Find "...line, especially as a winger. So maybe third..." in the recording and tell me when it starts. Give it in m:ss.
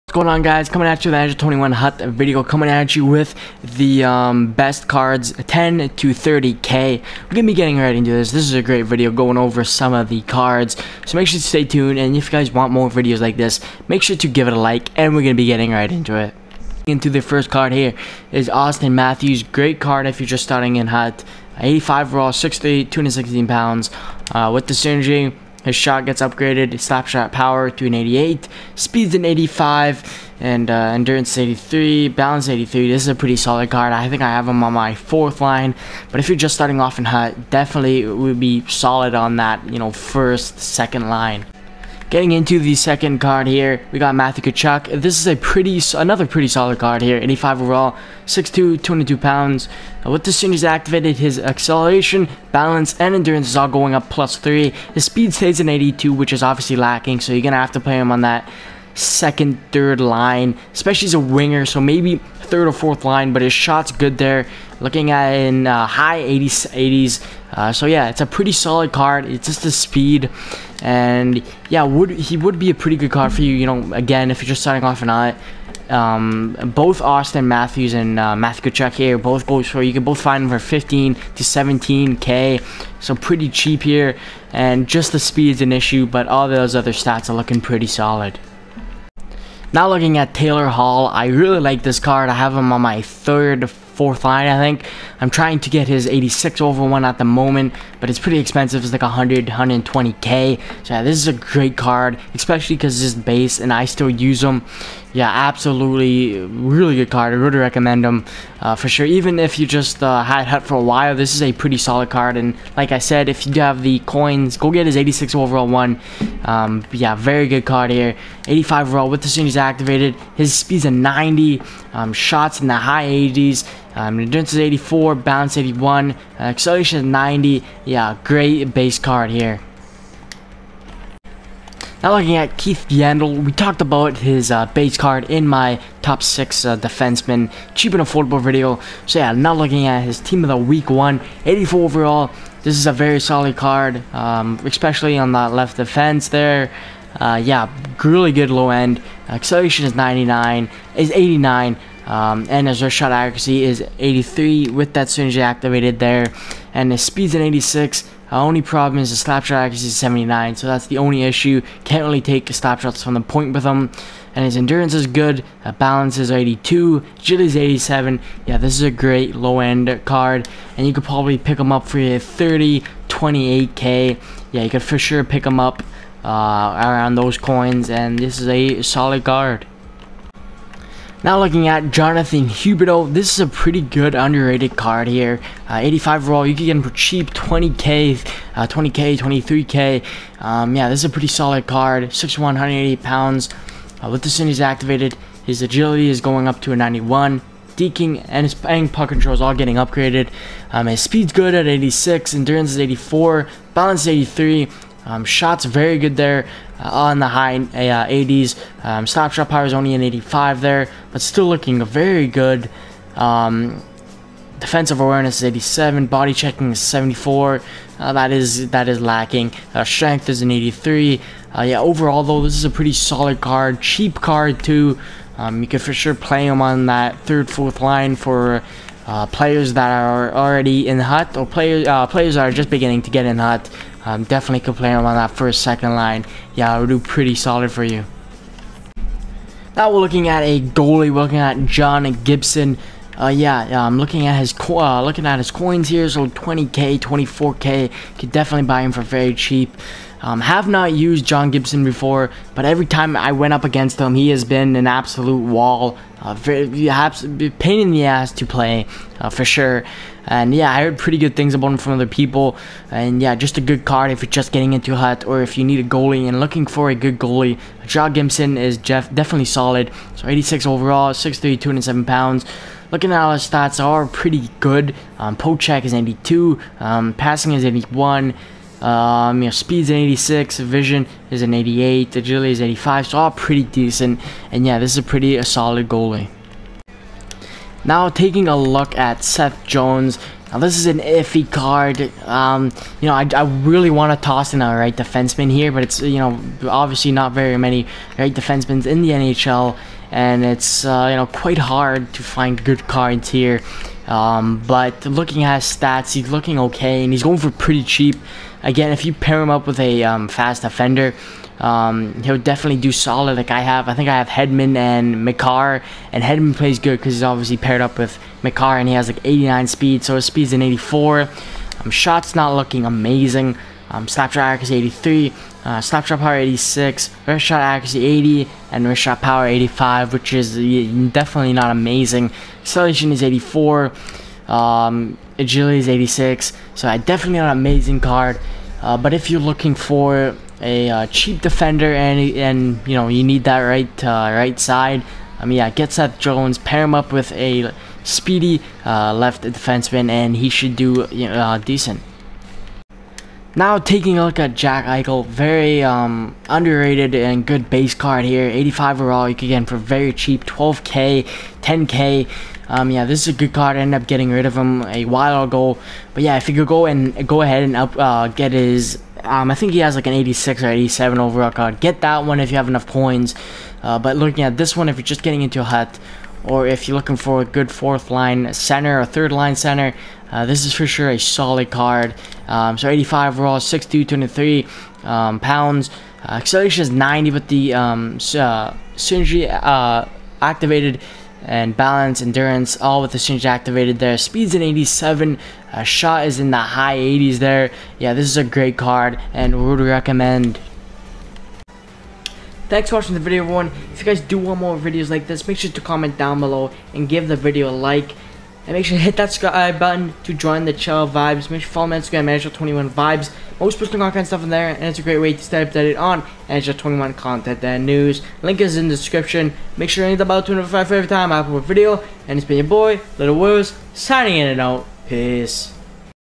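1:00.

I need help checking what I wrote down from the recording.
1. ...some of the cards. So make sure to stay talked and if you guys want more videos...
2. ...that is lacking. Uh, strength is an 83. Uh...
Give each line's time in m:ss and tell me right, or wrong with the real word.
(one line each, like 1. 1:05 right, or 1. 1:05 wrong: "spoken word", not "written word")
1. 0:09 wrong: "tuned", not "talked"
2. 3:38 right.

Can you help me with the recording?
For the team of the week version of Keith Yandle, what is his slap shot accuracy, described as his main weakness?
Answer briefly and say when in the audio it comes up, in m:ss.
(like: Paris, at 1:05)
79, at 2:39.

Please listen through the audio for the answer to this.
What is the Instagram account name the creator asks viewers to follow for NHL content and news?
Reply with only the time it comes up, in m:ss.
6:52.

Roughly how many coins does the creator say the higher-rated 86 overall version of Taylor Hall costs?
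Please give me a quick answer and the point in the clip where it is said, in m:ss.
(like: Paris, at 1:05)
100k to 120k, at 1:39.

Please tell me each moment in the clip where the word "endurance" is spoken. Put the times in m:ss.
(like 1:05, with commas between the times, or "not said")
0:30, 0:53, 2:04, 2:44, 3:22, 6:32.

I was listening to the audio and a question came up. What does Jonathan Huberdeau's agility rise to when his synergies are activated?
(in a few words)
91.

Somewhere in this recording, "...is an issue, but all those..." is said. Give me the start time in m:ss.
1:25.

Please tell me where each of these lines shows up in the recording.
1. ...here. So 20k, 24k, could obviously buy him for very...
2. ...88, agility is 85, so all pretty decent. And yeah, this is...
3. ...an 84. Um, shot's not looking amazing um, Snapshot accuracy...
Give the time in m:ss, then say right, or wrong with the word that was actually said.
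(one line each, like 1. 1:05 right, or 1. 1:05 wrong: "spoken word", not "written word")
1. 4:05 wrong: "definitely", not "obviously"
2. 4:41 right
3. 5:20 right.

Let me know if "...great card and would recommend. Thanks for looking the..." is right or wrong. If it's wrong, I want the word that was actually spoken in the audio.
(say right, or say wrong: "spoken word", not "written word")
wrong: "watching", not "looking".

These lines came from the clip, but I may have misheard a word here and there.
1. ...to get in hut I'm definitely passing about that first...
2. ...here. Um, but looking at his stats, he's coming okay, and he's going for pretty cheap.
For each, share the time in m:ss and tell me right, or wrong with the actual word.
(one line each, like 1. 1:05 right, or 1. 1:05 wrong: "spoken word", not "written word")
1. 3:53 wrong: "complaining", not "passing"
2. 5:03 wrong: "looking", not "coming".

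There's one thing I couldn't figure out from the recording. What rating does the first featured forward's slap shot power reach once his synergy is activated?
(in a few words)
88.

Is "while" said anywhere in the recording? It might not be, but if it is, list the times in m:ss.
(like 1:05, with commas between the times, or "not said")
1:50, 6:05.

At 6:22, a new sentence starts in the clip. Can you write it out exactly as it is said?
Um, so 85 overall, 6'2", 23 um, pounds.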